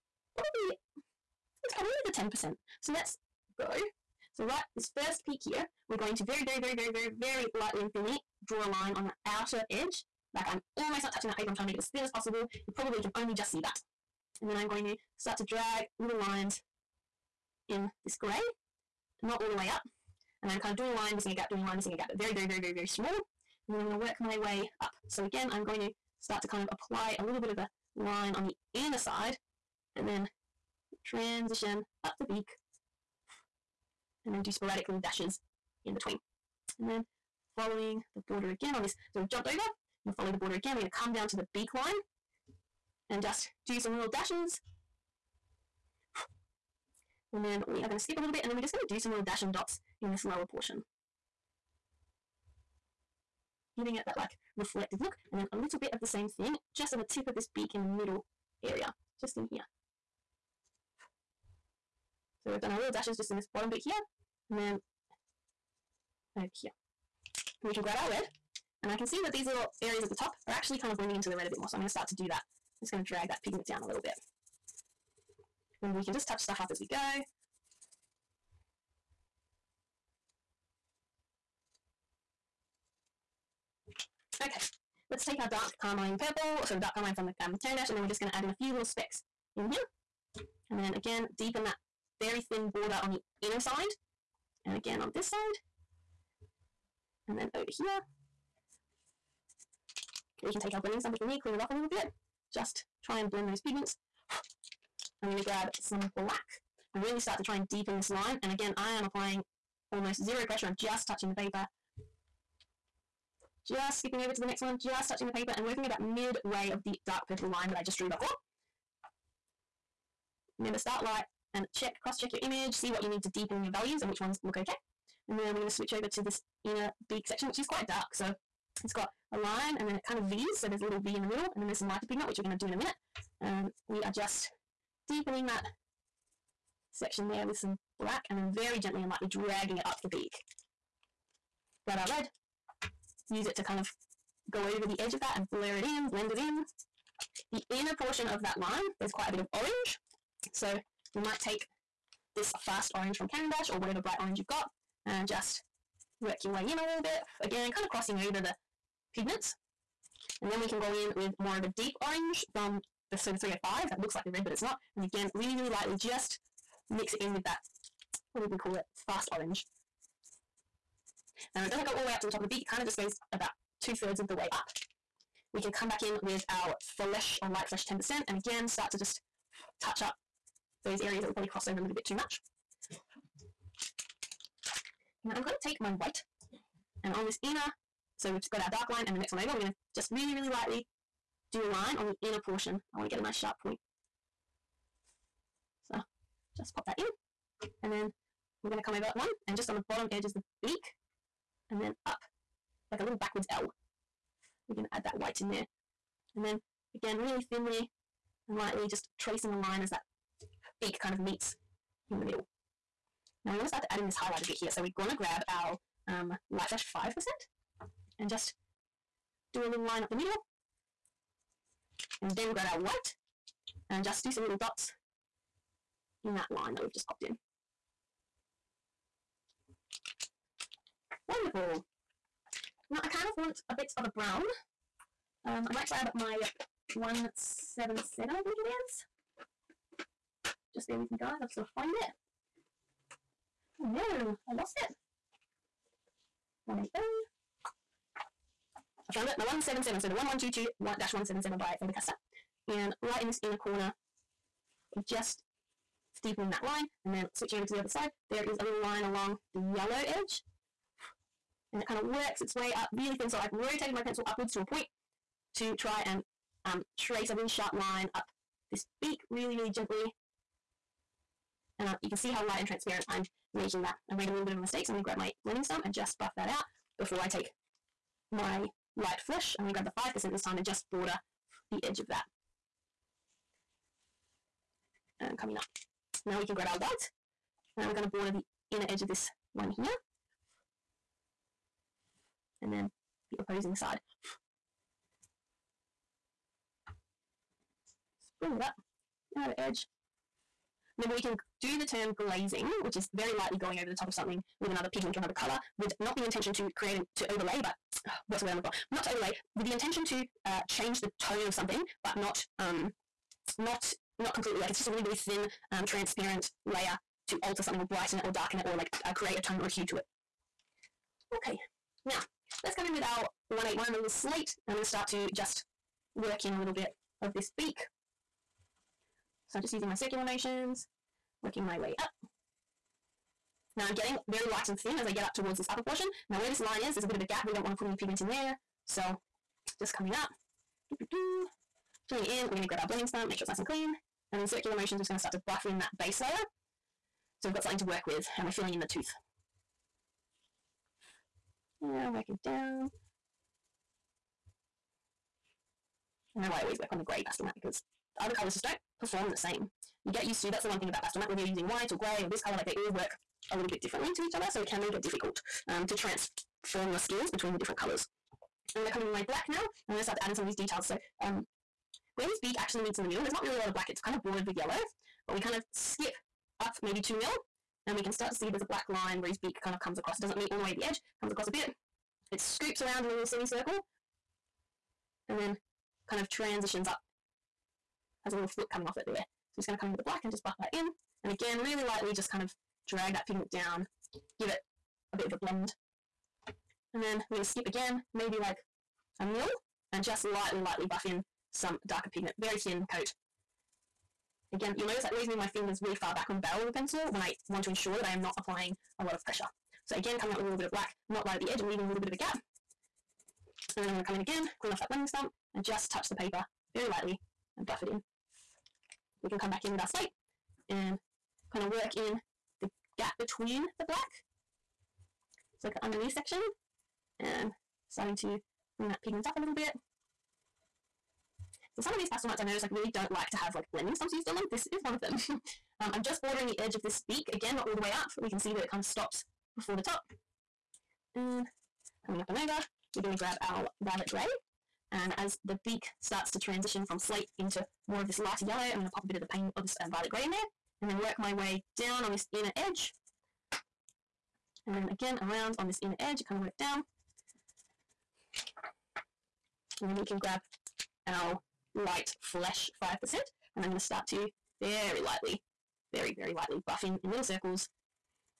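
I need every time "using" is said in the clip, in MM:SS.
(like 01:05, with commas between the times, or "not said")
05:29, 06:01.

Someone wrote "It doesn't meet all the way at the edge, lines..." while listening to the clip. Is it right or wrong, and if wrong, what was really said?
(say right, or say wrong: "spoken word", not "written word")
wrong: "comes", not "lines".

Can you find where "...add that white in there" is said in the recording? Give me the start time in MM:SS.
03:24.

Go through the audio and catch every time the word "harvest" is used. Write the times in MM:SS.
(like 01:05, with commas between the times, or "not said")
not said.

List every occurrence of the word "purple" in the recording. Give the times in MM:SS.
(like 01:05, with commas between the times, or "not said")
01:26, 01:57.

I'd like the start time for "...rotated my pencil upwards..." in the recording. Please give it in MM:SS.
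04:23.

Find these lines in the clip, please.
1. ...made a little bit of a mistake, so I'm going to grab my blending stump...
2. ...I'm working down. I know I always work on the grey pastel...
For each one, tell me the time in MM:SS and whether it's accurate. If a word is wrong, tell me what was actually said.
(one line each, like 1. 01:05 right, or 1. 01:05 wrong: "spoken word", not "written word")
1. 04:34 right
2. 05:52 right.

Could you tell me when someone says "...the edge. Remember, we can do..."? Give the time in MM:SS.
04:59.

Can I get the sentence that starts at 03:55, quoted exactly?
Um, I might grab my 177, I think it is.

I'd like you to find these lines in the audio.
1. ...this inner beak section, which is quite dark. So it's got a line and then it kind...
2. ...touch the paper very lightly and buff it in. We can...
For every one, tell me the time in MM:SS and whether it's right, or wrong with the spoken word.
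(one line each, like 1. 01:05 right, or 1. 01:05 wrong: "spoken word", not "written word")
1. 02:06 right
2. 06:55 right.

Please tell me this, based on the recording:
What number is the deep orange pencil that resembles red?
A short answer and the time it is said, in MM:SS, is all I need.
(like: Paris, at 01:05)
305, at 02:43.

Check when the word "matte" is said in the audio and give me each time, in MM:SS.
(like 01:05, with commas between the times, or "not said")
06:01.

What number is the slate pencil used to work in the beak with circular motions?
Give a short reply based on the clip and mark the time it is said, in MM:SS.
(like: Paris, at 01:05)
181, at 05:23.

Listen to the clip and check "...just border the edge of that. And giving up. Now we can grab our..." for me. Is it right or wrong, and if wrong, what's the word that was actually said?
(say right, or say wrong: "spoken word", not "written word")
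wrong: "coming", not "giving".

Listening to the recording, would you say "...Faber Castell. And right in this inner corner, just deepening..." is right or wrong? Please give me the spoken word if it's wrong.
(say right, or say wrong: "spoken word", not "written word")
right.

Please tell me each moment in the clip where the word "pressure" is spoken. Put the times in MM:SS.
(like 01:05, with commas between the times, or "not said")
01:50, 06:49.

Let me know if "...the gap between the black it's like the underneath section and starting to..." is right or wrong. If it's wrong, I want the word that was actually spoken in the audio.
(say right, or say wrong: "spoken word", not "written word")
right.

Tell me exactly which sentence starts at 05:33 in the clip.
Now I'm getting very light and thin as I get up towards this upper portion.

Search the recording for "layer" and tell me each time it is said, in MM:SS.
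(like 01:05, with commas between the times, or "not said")
05:16, 05:46.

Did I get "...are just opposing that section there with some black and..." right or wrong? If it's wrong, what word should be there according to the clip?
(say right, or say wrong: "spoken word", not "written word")
wrong: "deepening", not "opposing".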